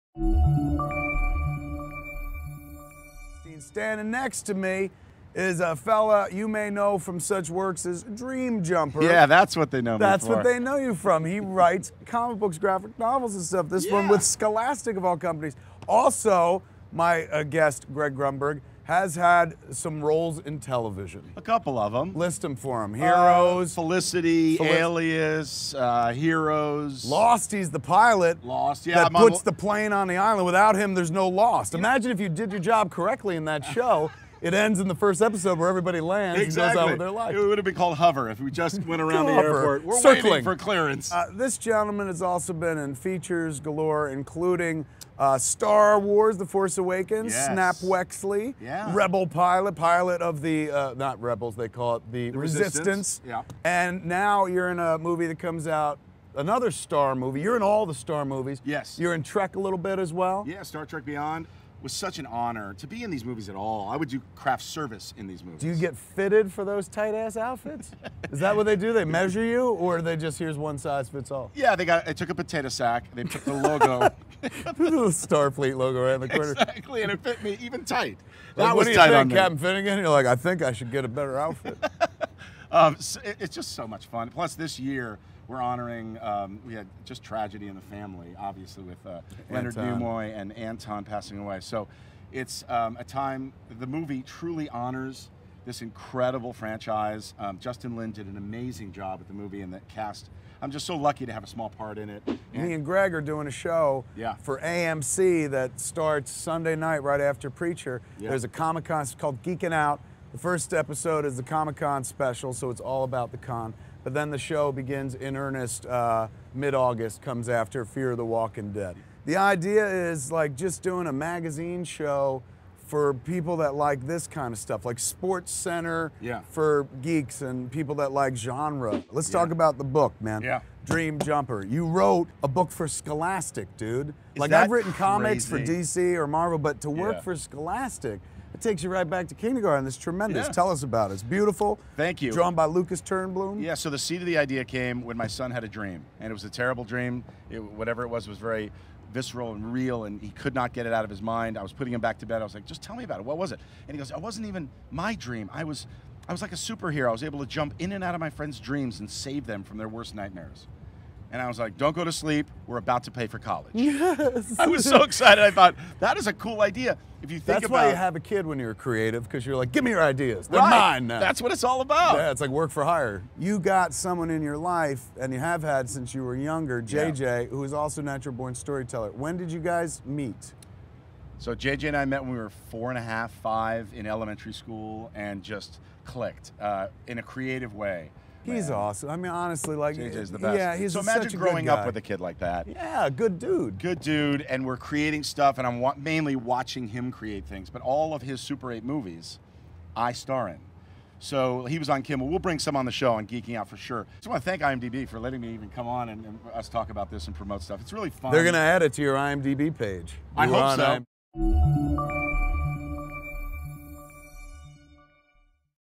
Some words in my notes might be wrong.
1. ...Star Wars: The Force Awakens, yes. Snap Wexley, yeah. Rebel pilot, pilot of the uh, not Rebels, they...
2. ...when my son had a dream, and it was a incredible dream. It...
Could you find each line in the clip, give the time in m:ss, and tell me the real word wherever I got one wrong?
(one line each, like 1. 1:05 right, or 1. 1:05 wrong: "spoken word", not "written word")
1. 0:45 right
2. 2:25 wrong: "terrible", not "incredible".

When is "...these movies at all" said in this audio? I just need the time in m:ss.
1:03.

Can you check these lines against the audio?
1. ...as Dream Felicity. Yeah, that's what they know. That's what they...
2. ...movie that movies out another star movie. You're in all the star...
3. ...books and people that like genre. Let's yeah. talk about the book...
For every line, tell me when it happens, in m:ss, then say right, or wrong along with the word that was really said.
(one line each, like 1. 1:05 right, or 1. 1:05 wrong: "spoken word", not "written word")
1. 0:07 wrong: "Jumper", not "Felicity"
2. 0:54 wrong: "comes", not "movies"
3. 2:07 wrong: "geeks", not "books".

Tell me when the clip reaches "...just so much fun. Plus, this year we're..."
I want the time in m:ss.
1:23.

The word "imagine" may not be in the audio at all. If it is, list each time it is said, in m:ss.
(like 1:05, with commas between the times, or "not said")
0:31, 3:10.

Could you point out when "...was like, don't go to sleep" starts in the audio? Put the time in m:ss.
2:41.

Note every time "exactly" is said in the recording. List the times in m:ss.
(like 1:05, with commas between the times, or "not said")
0:36, 1:16.